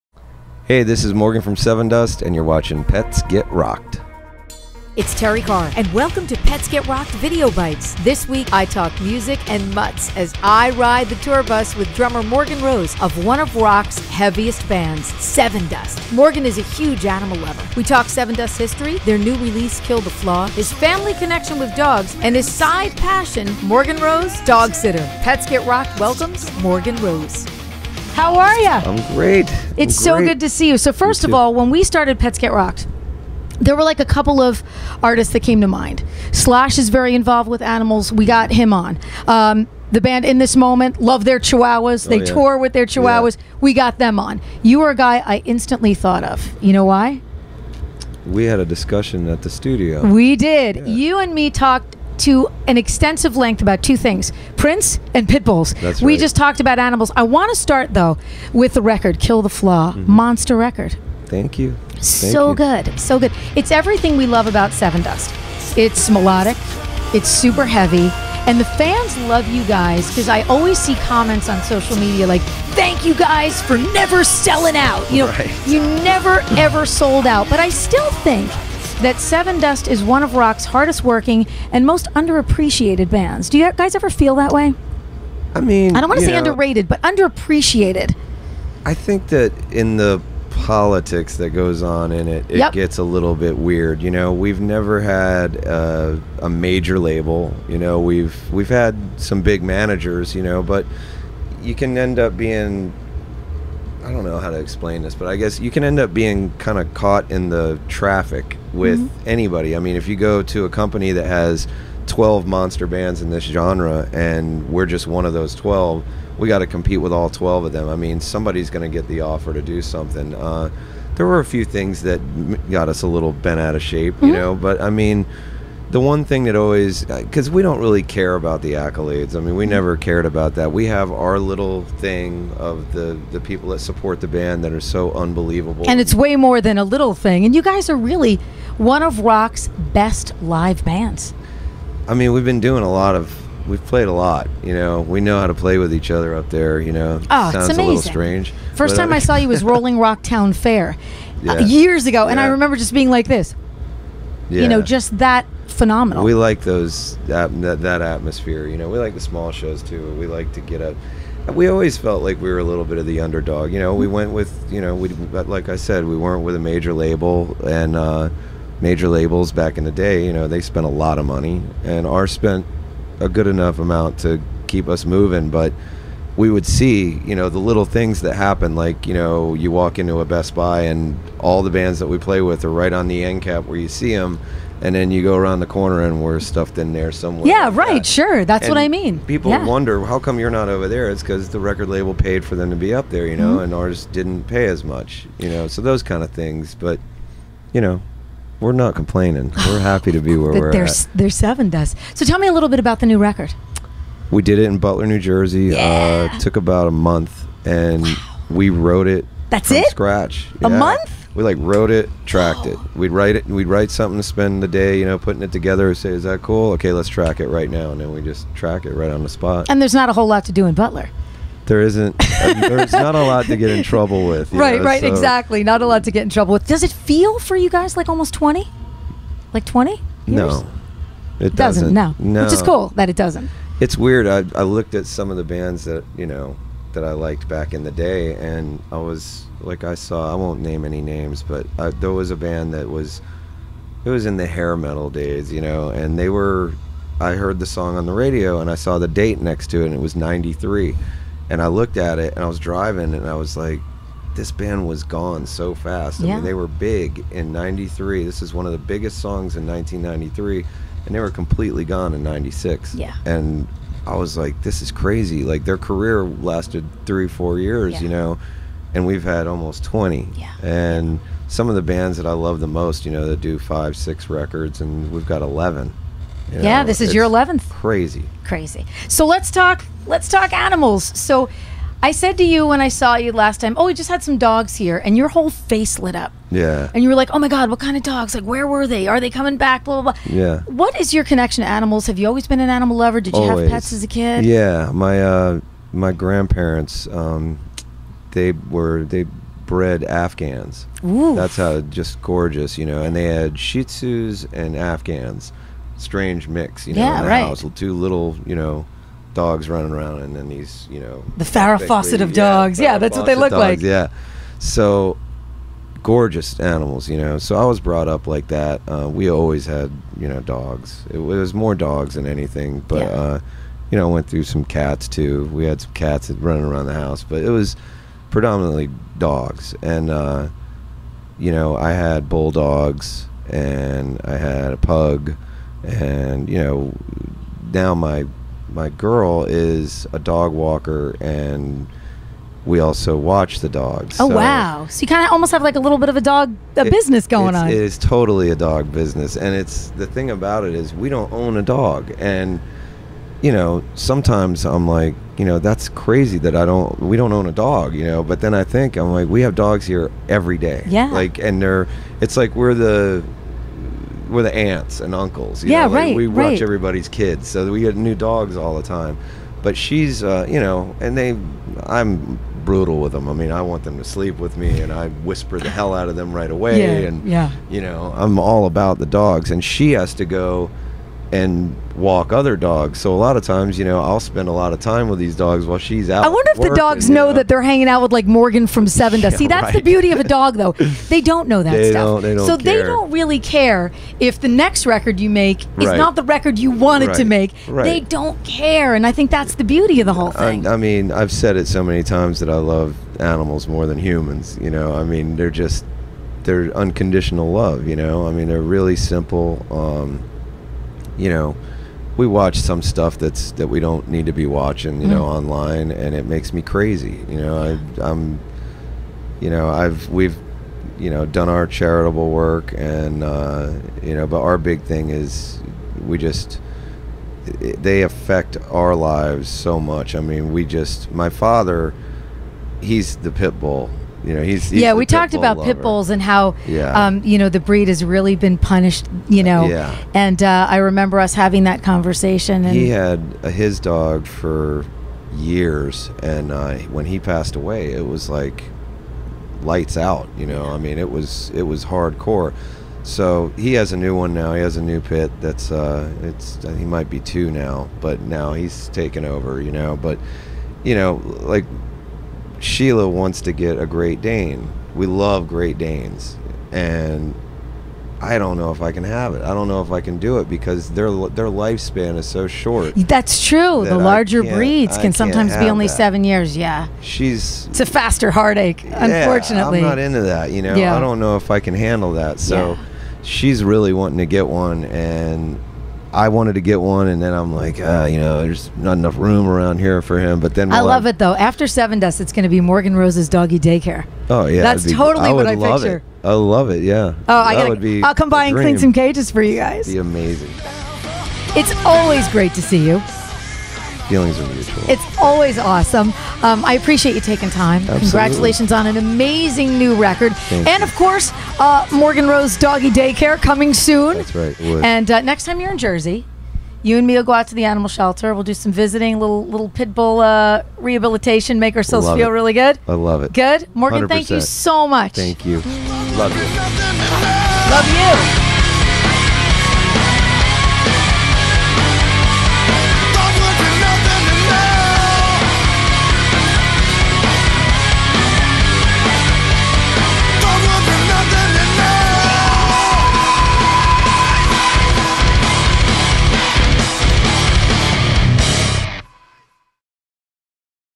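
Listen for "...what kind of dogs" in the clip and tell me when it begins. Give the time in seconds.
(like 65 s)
287 s.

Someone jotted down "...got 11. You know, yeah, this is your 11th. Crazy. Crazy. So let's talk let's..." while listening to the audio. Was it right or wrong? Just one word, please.
right.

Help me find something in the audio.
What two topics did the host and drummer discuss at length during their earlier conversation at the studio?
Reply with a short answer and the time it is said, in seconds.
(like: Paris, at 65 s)
Prince and pit bulls, at 54 s.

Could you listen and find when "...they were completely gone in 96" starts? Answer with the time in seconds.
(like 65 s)
261 s.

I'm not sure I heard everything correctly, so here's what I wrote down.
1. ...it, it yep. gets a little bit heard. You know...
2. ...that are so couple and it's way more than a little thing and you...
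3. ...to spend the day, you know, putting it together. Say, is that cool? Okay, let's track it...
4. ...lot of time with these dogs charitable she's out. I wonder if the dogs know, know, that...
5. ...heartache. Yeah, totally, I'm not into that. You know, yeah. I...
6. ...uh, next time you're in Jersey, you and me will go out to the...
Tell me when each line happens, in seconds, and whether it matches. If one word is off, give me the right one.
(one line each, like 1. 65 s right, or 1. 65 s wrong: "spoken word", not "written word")
1. 92 s wrong: "weird", not "heard"
2. 134 s wrong: "unbelievable", not "couple"
3. 214 s right
4. 384 s wrong: "while", not "charitable"
5. 478 s wrong: "unfortunately", not "totally"
6. 515 s right.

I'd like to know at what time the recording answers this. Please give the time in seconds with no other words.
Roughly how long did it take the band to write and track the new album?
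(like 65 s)
206 s.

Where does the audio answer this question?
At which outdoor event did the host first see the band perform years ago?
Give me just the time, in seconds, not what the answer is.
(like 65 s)
149 s.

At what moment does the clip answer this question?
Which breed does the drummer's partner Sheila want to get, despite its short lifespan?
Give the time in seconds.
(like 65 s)
463 s.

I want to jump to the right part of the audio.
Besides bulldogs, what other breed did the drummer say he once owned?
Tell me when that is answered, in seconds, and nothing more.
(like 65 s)
334 s.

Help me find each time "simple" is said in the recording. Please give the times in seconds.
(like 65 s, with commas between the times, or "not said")
408 s.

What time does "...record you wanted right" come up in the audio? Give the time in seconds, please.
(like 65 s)
396 s.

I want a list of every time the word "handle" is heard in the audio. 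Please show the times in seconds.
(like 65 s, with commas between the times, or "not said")
481 s.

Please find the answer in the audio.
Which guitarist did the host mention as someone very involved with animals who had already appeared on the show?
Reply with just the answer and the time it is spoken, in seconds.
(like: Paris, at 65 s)
Slash, at 36 s.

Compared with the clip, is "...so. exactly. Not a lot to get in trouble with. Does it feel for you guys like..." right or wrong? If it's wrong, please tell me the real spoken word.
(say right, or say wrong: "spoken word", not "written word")
right.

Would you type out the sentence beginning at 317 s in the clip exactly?
So I was brought up like that.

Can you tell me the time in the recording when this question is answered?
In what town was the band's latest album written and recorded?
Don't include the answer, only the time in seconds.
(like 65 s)
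204 s.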